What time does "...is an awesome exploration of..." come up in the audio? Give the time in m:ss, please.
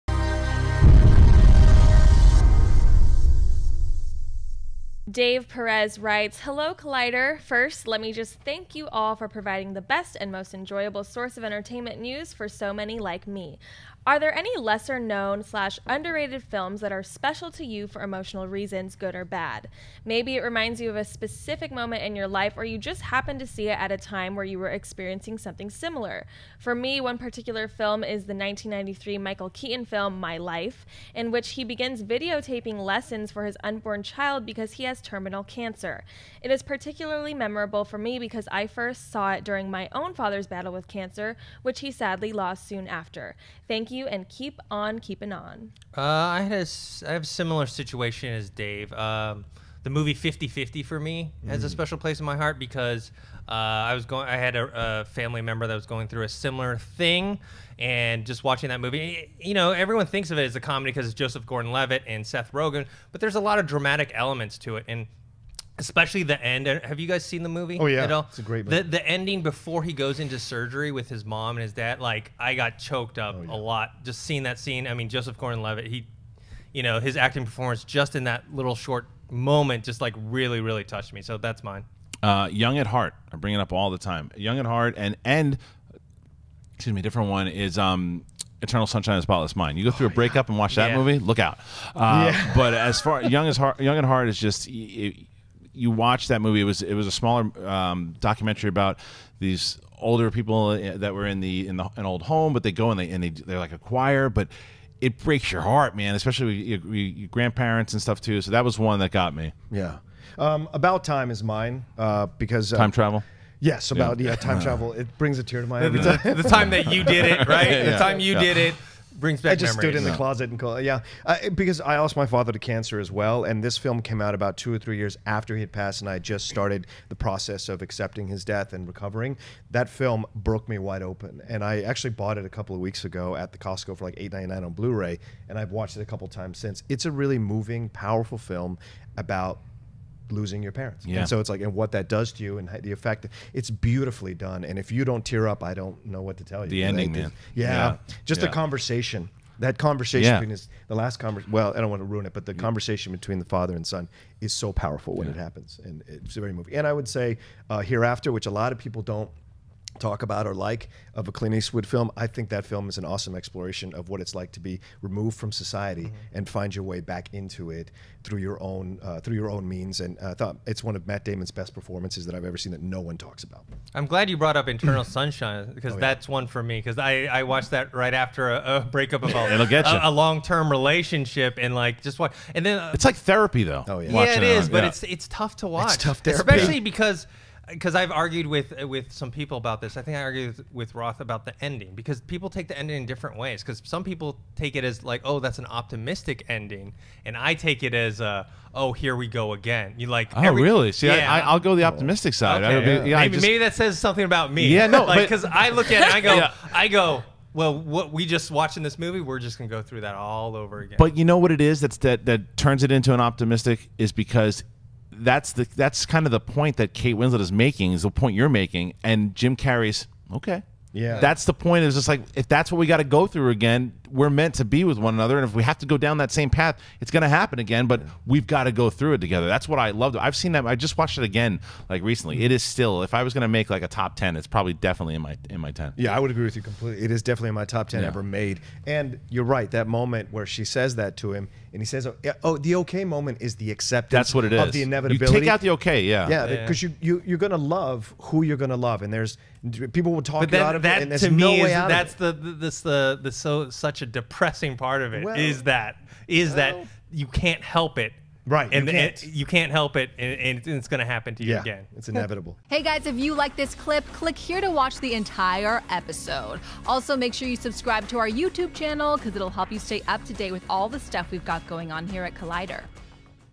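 2:42.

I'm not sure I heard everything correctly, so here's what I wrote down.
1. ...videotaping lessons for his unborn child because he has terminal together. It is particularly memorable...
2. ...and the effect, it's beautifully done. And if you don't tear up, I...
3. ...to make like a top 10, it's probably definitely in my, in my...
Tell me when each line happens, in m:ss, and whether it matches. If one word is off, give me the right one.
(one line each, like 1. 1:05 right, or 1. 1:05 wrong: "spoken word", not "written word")
1. 0:32 wrong: "cancer", not "together"
2. 2:22 right
3. 3:53 right.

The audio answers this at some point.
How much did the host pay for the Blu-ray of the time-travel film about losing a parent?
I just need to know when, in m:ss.
2:14.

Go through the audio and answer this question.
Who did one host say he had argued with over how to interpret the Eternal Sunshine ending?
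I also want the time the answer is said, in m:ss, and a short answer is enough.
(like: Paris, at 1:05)
Roth, at 3:10.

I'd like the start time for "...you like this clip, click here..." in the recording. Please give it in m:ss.
4:23.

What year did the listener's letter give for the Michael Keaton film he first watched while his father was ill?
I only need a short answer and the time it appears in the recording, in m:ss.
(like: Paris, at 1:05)
1993, at 0:28.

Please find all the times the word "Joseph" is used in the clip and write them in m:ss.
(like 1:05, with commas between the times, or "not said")
1:01, 1:15.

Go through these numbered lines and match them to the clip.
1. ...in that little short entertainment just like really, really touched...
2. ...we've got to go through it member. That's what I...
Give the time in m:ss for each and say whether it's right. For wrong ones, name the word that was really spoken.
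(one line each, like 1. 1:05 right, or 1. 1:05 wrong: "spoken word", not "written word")
1. 1:18 wrong: "moment", not "entertainment"
2. 3:48 wrong: "together", not "member".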